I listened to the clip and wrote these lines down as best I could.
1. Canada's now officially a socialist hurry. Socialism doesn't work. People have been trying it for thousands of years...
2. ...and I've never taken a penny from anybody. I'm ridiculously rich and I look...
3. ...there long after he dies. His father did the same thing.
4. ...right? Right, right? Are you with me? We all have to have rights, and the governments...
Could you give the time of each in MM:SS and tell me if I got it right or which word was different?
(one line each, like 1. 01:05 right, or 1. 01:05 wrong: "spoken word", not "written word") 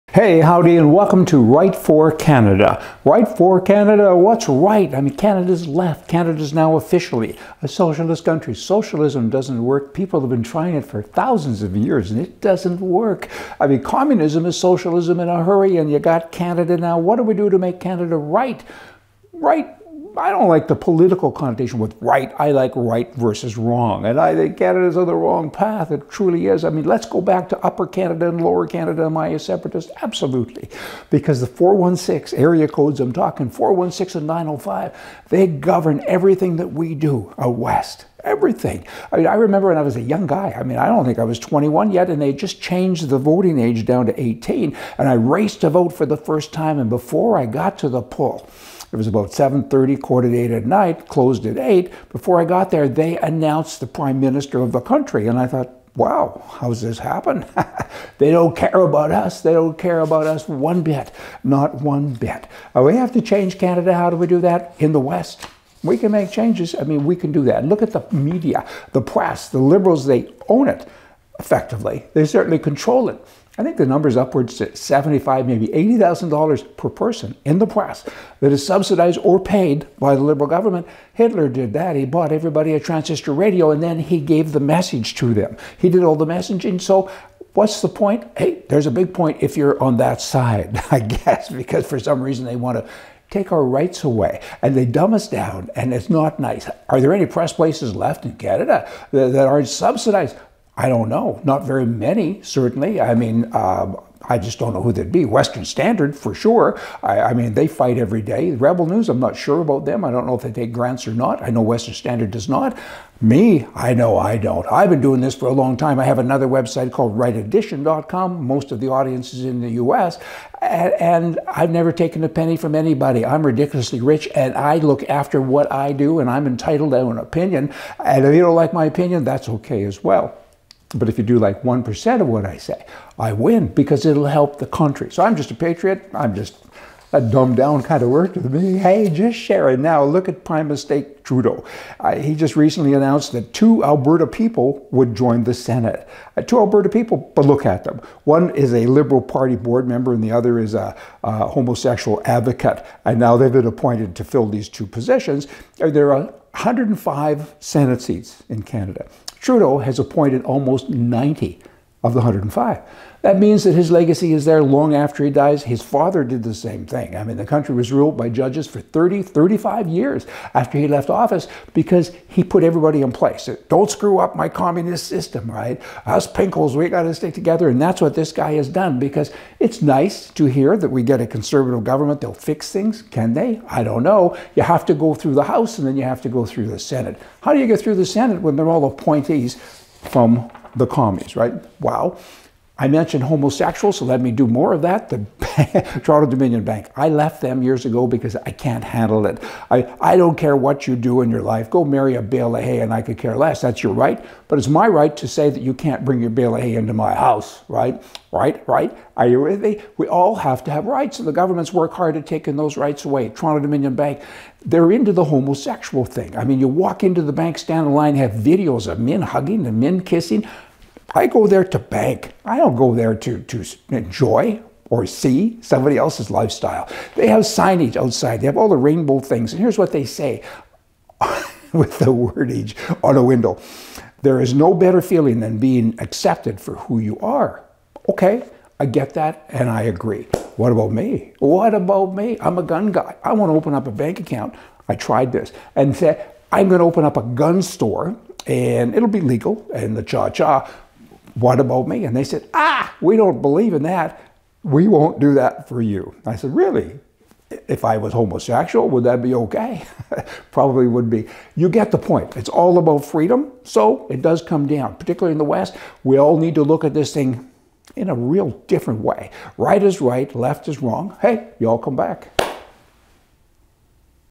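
1. 00:06 wrong: "country", not "hurry"
2. 02:00 right
3. 02:44 right
4. 03:27 right.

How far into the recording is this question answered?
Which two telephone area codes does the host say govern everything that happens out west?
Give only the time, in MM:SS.
00:33.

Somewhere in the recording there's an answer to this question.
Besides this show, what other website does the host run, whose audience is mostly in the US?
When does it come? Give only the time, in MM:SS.
01:57.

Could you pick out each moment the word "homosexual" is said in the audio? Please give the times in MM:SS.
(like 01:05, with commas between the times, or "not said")
02:31, 03:13, 03:35, 04:18.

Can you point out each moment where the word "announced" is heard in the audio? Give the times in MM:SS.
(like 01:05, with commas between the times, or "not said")
00:53, 02:22.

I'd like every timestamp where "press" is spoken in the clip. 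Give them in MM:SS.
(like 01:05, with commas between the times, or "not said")
01:09, 01:17, 01:37.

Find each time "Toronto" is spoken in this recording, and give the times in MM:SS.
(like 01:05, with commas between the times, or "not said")
03:16, 03:33.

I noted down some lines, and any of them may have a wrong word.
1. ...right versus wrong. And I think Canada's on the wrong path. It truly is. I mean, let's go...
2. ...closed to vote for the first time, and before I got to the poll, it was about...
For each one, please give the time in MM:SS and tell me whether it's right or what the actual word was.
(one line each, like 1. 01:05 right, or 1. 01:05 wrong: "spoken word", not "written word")
1. 00:22 right
2. 00:45 wrong: "raced", not "closed".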